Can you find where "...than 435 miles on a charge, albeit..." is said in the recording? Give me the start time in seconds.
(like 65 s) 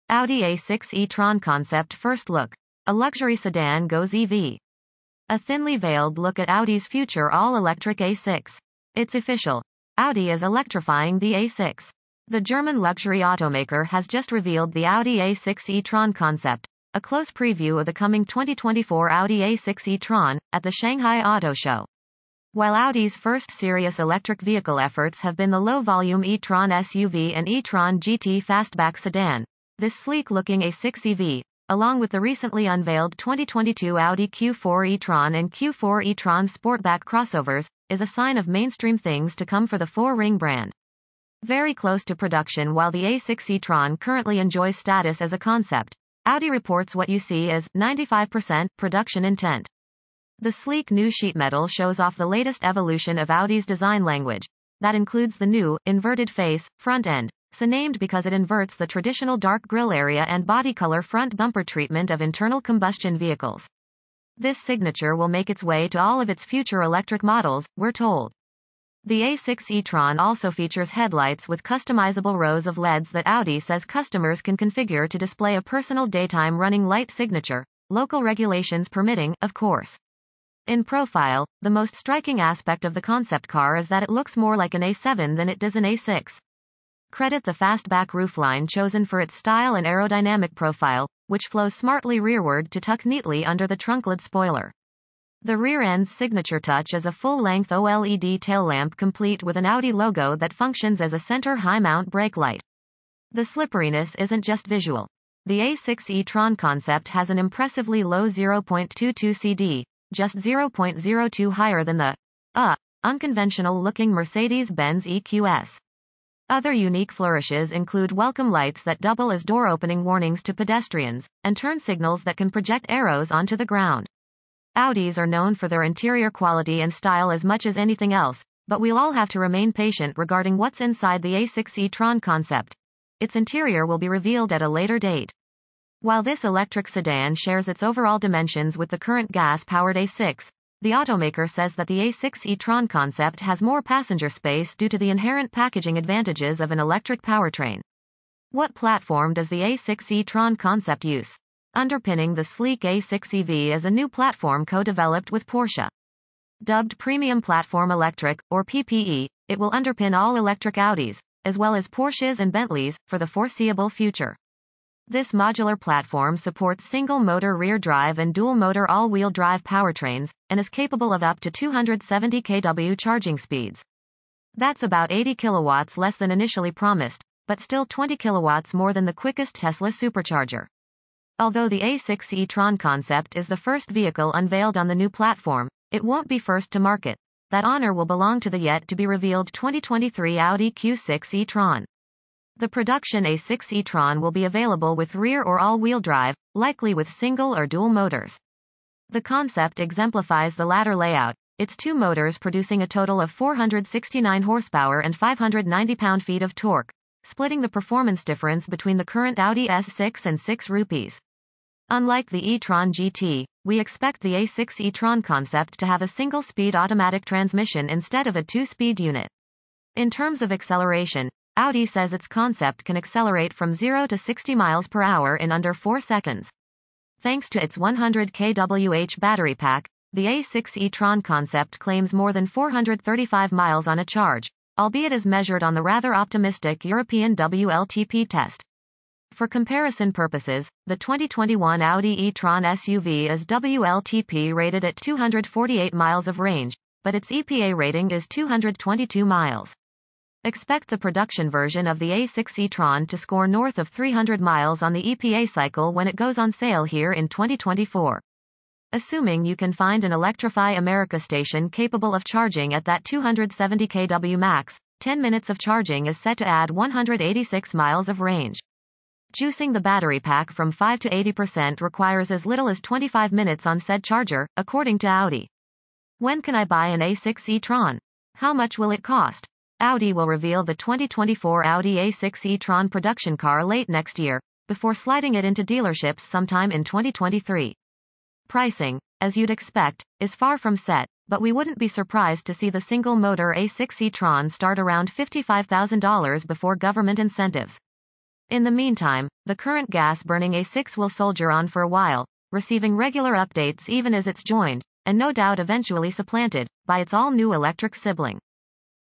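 232 s.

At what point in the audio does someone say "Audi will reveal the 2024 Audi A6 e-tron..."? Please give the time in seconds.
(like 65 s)
279 s.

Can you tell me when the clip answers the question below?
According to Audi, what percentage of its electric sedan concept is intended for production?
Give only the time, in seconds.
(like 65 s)
47 s.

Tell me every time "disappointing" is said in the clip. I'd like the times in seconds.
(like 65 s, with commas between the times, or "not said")
not said.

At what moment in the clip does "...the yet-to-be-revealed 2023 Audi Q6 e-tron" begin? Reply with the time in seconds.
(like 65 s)
188 s.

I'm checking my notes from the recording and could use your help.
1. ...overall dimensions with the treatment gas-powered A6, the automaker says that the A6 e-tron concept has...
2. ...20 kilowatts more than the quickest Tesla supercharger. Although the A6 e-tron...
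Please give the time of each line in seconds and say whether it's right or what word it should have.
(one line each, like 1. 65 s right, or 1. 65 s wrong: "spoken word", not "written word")
1. 137 s wrong: "current", not "treatment"
2. 177 s right.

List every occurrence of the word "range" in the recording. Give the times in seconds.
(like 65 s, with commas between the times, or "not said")
246 s, 268 s.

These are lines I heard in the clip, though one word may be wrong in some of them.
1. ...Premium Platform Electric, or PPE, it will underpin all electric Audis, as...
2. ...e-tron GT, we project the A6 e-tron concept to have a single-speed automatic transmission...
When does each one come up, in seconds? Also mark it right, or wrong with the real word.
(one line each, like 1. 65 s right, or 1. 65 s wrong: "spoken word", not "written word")
1. 156 s right
2. 212 s wrong: "expect", not "project".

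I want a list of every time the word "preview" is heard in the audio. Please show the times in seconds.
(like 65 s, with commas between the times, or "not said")
17 s.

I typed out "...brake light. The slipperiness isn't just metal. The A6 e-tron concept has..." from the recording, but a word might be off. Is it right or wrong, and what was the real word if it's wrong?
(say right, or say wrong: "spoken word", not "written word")
wrong: "visual", not "metal".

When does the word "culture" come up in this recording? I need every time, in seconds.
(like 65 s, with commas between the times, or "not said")
not said.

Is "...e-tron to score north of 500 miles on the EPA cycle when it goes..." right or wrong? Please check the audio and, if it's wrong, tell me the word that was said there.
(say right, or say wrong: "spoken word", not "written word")
wrong: "300", not "500".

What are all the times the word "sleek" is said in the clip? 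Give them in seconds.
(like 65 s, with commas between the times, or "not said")
29 s, 50 s, 152 s.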